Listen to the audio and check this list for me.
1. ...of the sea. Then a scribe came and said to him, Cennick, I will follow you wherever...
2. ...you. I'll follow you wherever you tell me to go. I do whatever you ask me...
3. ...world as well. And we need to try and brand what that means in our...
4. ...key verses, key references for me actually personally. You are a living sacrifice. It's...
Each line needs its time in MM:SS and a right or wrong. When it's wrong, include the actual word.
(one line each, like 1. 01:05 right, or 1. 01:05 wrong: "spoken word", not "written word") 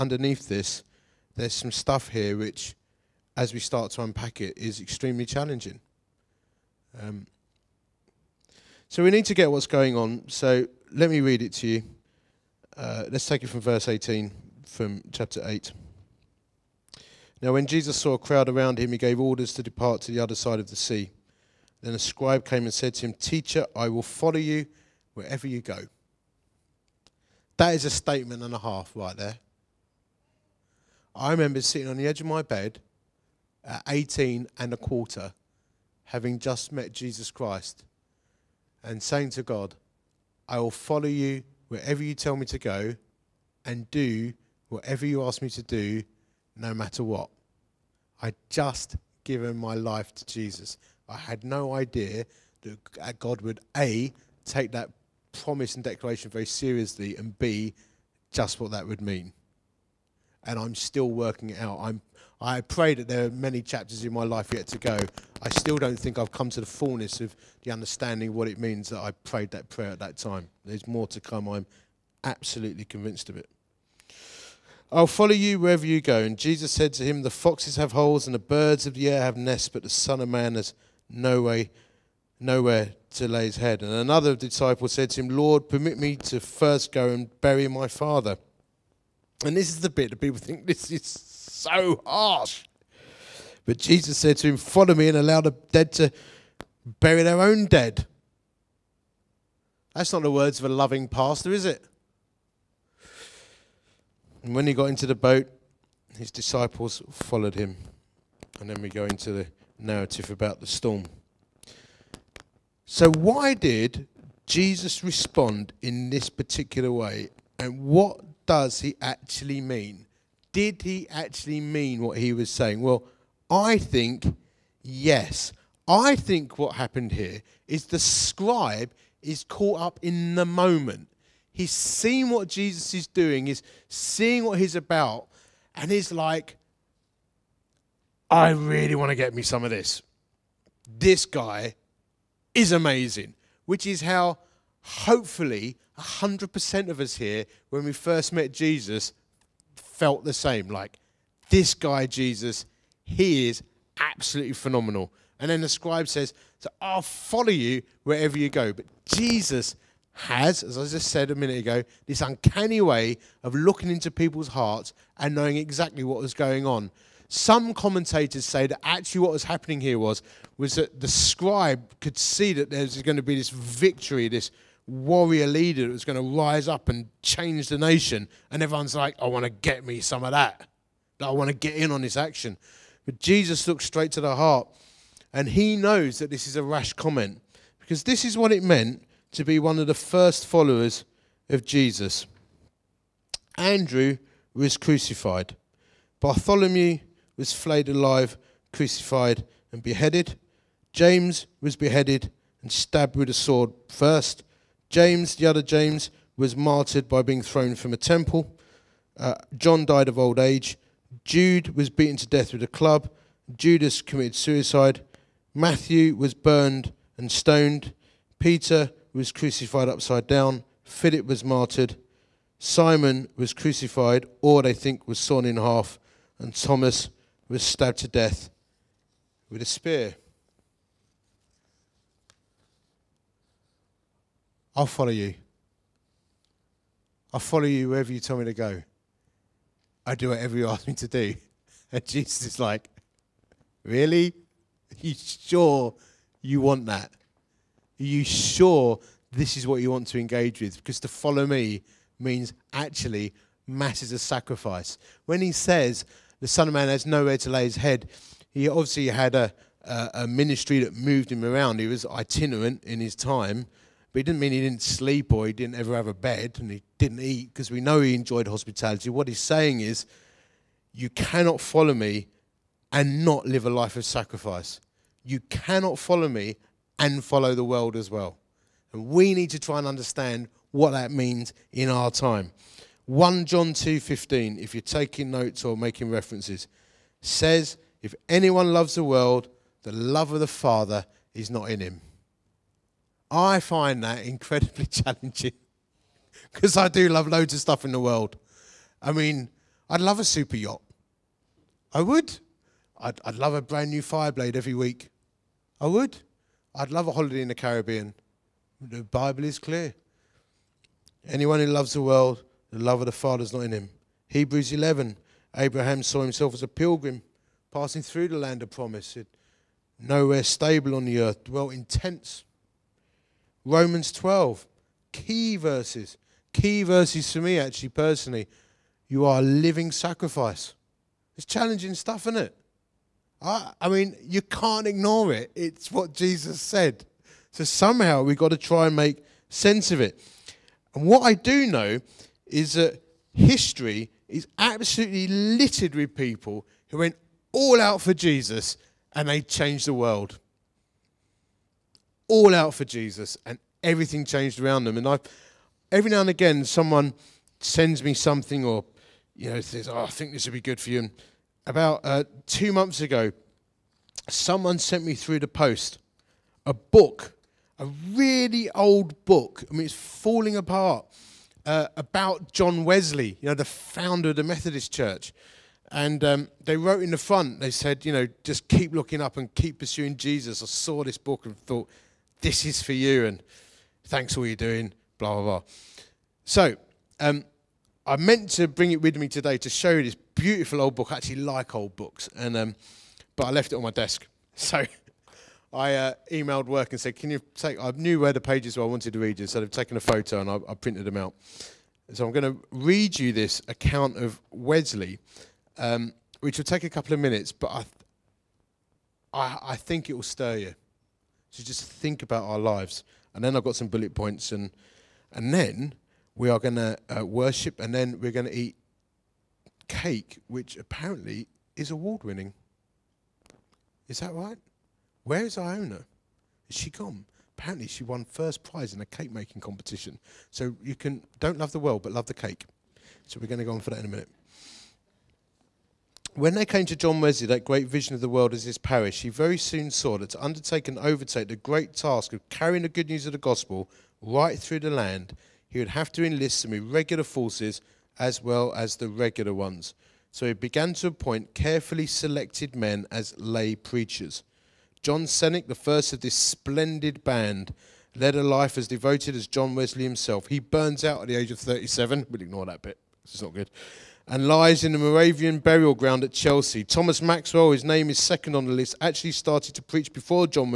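1. 00:20 wrong: "Teacher", not "Cennick"
2. 03:55 right
3. 04:37 wrong: "understand", not "brand"
4. 05:25 wrong: "verses", not "references".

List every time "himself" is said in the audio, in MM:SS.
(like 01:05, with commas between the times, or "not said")
05:16, 07:40.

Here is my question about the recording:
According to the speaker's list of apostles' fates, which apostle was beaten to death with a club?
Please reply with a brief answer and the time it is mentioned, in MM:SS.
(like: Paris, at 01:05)
Jude, at 03:31.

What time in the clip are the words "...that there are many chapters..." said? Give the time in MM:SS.
01:02.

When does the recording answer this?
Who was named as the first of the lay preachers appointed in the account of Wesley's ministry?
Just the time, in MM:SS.
07:35.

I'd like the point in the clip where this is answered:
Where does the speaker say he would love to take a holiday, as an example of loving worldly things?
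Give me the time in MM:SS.
05:07.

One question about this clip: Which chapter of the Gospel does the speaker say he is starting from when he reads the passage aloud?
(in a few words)
Chapter 8.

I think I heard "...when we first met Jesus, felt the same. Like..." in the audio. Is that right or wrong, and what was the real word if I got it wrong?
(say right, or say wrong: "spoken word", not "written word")
right.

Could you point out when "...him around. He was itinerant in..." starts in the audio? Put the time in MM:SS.
04:21.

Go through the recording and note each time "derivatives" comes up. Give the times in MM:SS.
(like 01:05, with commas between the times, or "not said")
not said.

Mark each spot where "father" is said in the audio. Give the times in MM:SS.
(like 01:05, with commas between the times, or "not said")
01:27, 04:50, 05:13.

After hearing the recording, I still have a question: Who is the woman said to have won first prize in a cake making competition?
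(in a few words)
Iona.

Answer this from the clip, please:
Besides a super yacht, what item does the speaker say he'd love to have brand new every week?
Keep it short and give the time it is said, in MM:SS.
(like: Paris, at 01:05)
Fireblade, at 05:04.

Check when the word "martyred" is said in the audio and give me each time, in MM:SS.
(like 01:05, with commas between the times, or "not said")
03:26, 03:41.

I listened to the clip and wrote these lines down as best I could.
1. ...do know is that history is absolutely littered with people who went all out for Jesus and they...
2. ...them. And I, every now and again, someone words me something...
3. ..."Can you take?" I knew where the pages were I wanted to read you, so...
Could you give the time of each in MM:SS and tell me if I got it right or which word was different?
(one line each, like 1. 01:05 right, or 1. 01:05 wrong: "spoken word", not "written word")
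1. 05:41 right
2. 05:54 wrong: "sends", not "words"
3. 06:37 right.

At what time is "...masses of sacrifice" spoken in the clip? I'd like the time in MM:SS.
04:13.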